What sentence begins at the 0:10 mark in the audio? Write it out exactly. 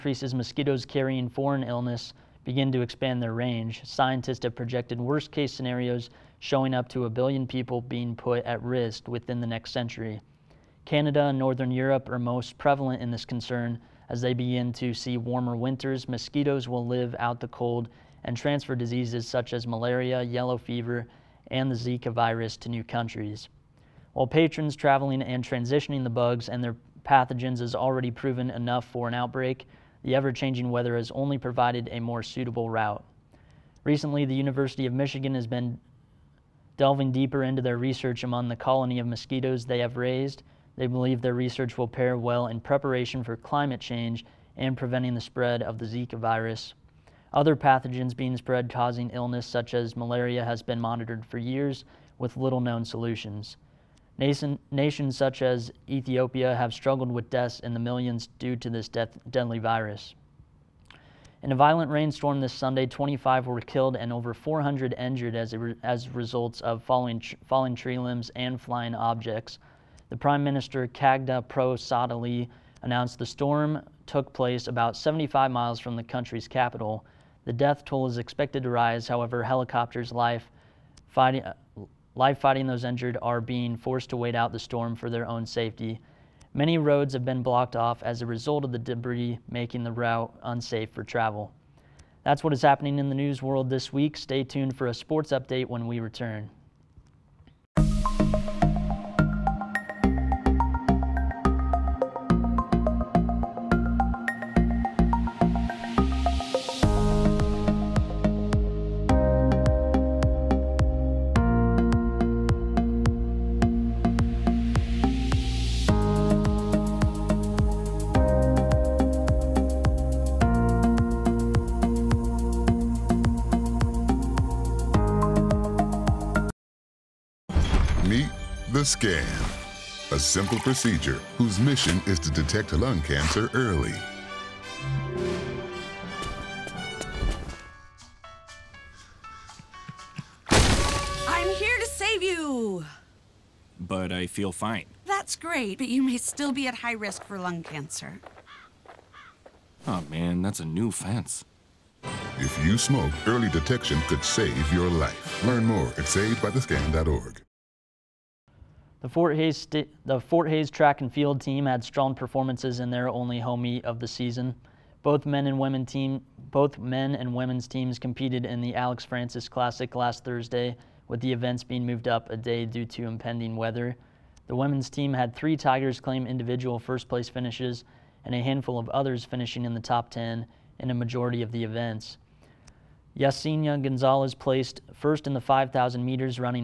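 Canada and Northern Europe are most prevalent in this concern.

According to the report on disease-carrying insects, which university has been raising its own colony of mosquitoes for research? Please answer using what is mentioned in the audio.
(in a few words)
University of Michigan.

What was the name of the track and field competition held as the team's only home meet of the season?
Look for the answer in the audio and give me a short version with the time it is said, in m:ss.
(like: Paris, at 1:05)
Alex Francis Classic, at 2:48.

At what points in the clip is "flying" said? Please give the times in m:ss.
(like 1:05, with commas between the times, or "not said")
1:08.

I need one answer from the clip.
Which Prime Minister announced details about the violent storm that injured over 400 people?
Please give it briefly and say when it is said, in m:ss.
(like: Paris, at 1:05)
Khadga Prasad Oli, at 1:10.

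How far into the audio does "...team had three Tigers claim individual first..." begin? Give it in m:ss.
2:54.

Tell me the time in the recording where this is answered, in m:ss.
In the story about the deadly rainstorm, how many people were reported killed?
1:02.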